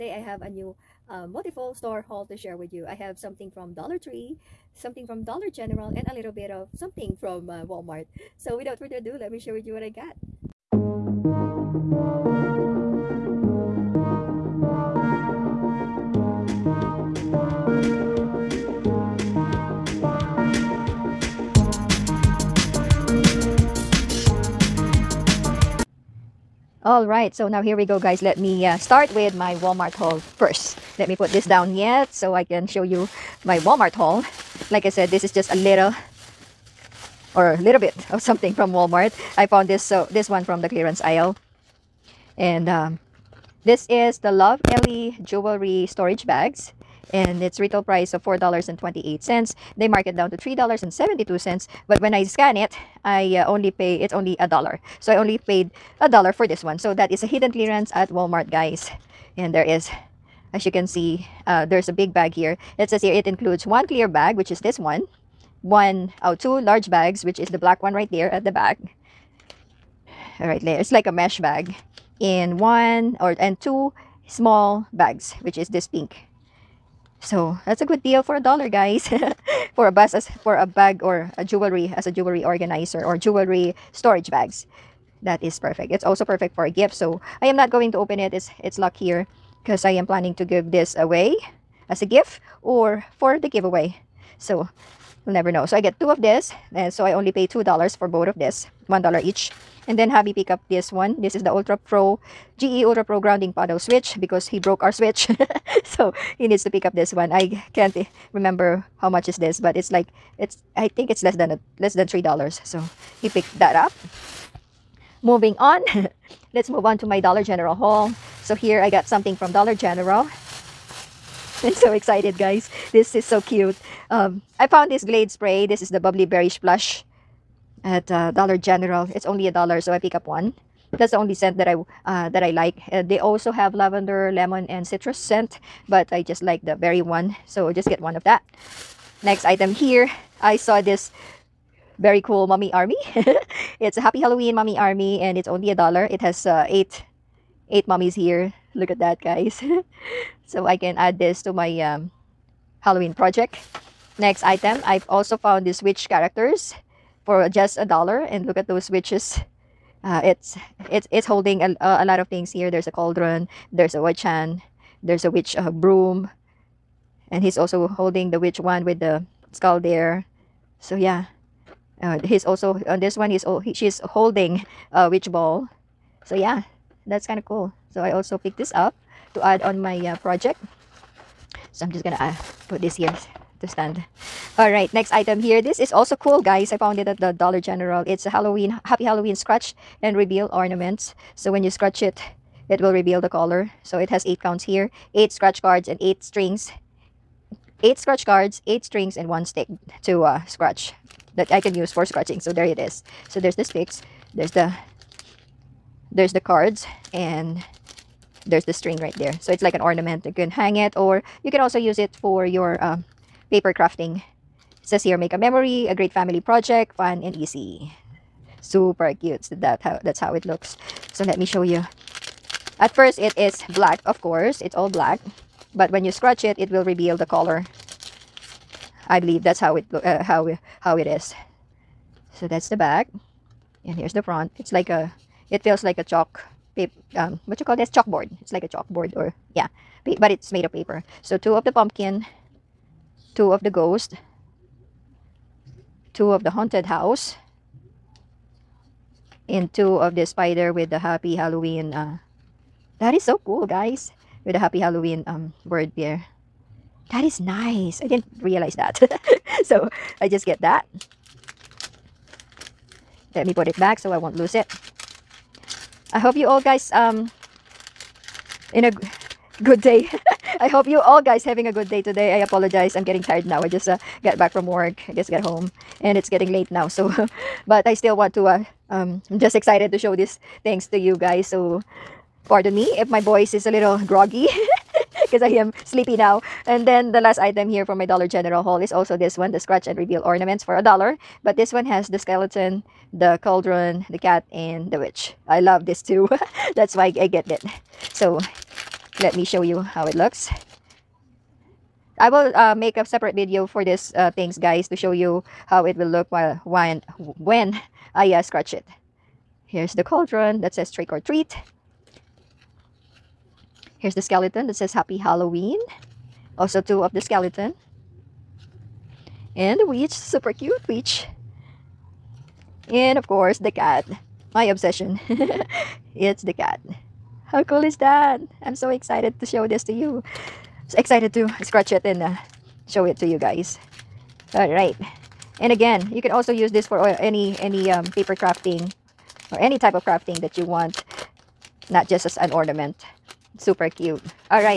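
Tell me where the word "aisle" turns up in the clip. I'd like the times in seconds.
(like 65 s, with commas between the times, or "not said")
41 s.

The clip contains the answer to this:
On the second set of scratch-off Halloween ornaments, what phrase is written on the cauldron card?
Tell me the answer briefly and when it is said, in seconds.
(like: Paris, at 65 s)
Trick or treat, at 310 s.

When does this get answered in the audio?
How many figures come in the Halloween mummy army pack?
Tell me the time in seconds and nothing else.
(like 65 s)
146 s.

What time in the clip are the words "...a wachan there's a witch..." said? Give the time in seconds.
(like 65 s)
163 s.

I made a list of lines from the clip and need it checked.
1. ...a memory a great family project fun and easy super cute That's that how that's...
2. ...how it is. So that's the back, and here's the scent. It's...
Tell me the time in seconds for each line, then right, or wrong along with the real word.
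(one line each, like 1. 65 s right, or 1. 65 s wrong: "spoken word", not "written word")
1. 215 s right
2. 230 s wrong: "front", not "scent".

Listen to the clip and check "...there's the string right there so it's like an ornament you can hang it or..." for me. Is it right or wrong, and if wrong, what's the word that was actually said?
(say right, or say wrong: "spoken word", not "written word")
right.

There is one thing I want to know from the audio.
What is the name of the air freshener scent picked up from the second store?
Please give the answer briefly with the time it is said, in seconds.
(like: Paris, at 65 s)
Bubbly Berry Splash, at 125 s.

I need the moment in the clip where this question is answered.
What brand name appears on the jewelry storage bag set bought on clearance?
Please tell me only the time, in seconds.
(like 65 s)
44 s.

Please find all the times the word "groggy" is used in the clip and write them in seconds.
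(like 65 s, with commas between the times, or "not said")
284 s.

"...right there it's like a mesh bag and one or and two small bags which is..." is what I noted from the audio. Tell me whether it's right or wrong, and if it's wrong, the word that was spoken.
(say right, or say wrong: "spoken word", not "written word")
right.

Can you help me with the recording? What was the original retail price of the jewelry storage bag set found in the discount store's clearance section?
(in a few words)
$4.28.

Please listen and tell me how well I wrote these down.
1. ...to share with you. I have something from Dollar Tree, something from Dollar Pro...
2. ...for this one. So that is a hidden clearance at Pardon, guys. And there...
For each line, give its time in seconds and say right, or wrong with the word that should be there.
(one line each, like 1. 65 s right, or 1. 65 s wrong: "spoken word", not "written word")
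1. 2 s wrong: "General", not "Pro"
2. 56 s wrong: "Walmart", not "Pardon".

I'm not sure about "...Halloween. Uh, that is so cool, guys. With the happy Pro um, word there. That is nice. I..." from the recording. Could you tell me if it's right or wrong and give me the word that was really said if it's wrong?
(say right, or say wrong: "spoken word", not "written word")
wrong: "Halloween", not "Pro".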